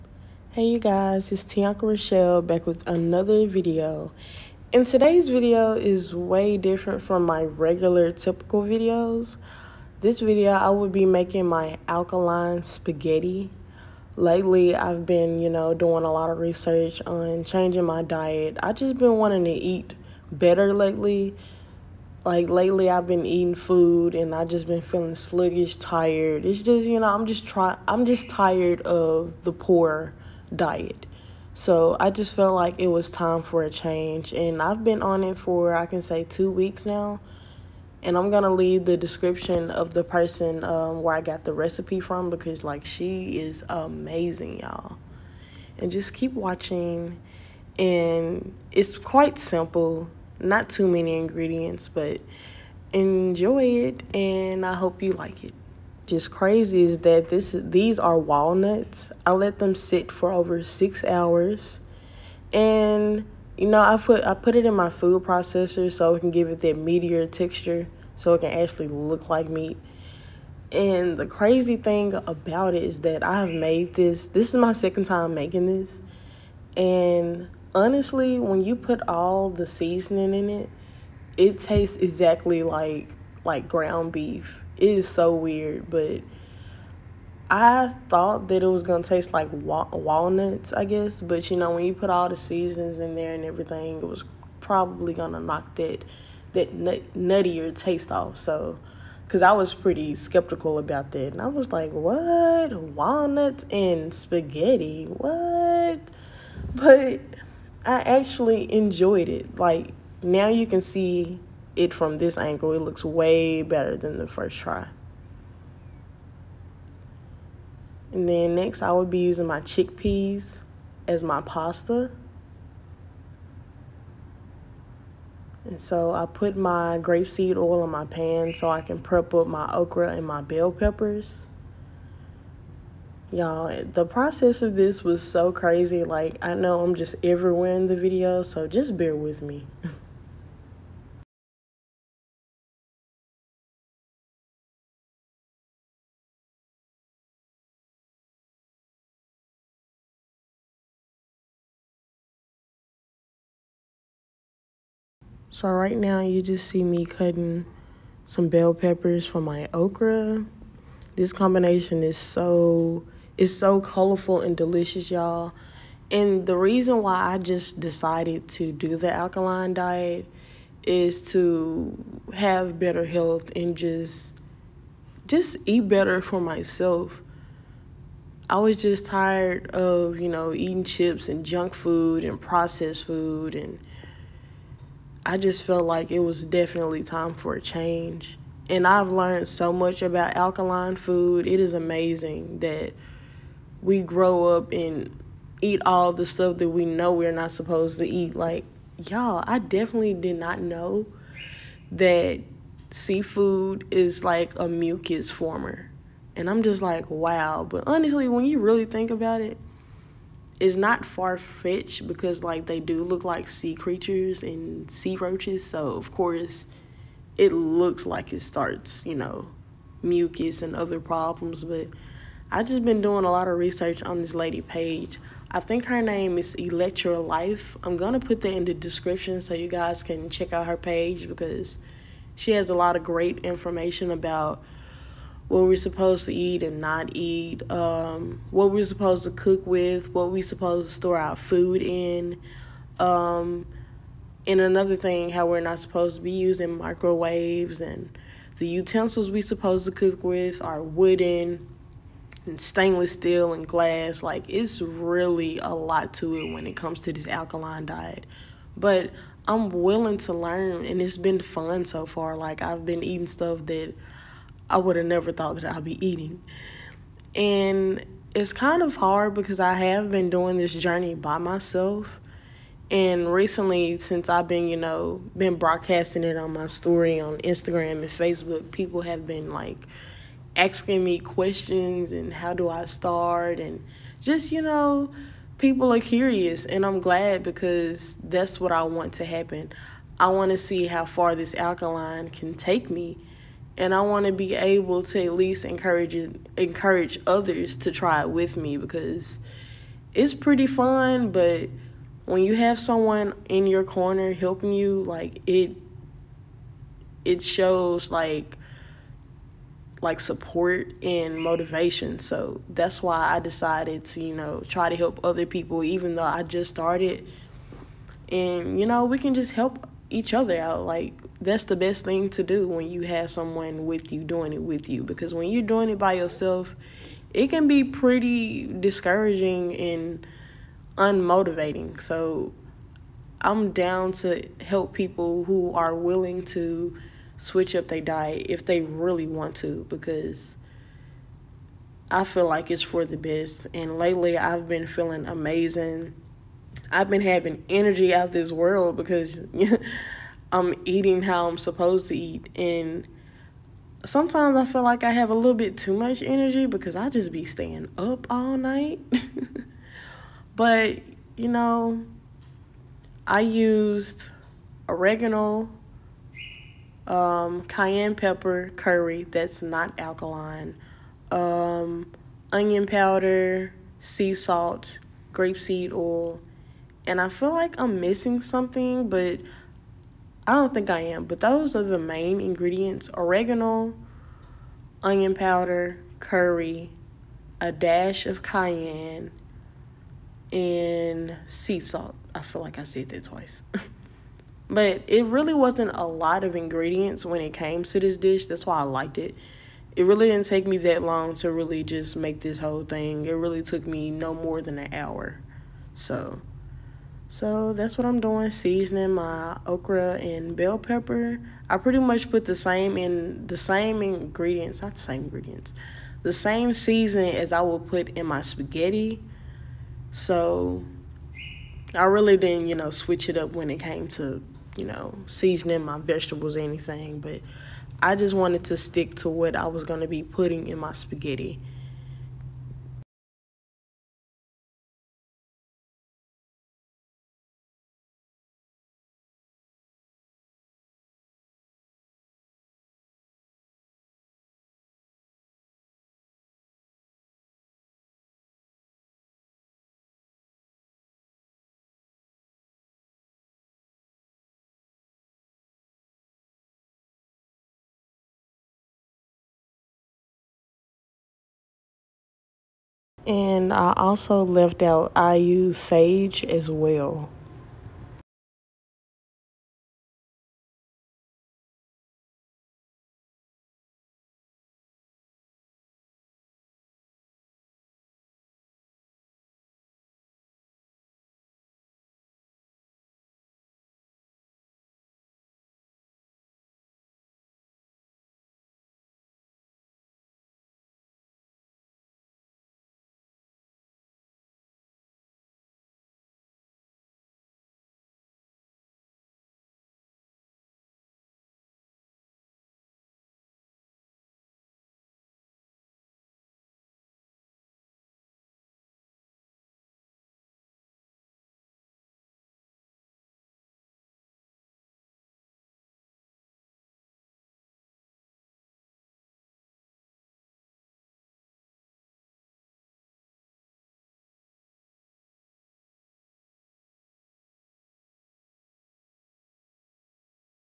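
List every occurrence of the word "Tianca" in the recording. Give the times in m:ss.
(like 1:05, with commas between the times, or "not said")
0:01.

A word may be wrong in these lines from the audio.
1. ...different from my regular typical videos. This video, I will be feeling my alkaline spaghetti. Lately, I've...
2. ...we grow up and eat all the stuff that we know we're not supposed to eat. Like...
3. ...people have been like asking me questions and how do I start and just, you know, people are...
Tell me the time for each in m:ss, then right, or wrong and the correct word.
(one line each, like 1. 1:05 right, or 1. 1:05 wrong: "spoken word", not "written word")
1. 0:06 wrong: "making", not "feeling"
2. 3:13 right
3. 4:38 right.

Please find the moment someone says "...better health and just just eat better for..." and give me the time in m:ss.
2:52.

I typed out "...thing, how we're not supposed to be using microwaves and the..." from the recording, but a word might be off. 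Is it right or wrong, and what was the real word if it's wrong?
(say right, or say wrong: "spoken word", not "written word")
right.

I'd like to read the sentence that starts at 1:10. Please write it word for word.
And the crazy thing about it is that I have made this.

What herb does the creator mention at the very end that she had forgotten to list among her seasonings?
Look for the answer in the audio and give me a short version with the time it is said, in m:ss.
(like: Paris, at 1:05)
sage, at 7:45.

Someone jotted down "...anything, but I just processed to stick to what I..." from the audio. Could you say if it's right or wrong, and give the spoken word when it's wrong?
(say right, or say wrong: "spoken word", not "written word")
wrong: "wanted", not "processed".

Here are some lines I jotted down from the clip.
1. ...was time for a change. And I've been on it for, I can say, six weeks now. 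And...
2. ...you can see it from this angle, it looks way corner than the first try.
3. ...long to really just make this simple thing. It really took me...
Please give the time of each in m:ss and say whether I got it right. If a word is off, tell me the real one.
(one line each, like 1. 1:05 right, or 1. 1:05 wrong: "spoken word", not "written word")
1. 0:32 wrong: "two", not "six"
2. 1:50 wrong: "better", not "corner"
3. 6:41 wrong: "whole", not "simple".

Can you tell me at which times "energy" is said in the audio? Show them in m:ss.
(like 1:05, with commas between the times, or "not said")
5:47, 5:56.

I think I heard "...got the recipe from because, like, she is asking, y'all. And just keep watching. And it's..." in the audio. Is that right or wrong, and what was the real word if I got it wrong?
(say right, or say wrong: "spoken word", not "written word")
wrong: "amazing", not "asking".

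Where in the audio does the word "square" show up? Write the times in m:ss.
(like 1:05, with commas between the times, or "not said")
not said.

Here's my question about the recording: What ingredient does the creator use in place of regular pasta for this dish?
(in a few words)
chickpeas.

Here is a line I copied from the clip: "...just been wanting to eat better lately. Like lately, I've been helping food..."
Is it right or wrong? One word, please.
wrong.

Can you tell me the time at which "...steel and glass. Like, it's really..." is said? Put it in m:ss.
4:13.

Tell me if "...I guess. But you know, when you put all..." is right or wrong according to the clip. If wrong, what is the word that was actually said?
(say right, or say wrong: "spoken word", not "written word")
right.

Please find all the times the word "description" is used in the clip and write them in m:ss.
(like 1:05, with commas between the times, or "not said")
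0:38, 3:48.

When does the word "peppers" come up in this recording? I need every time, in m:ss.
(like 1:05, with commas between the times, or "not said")
2:10, 2:38, 6:08, 6:50.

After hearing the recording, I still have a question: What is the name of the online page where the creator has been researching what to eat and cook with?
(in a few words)
Electra Life.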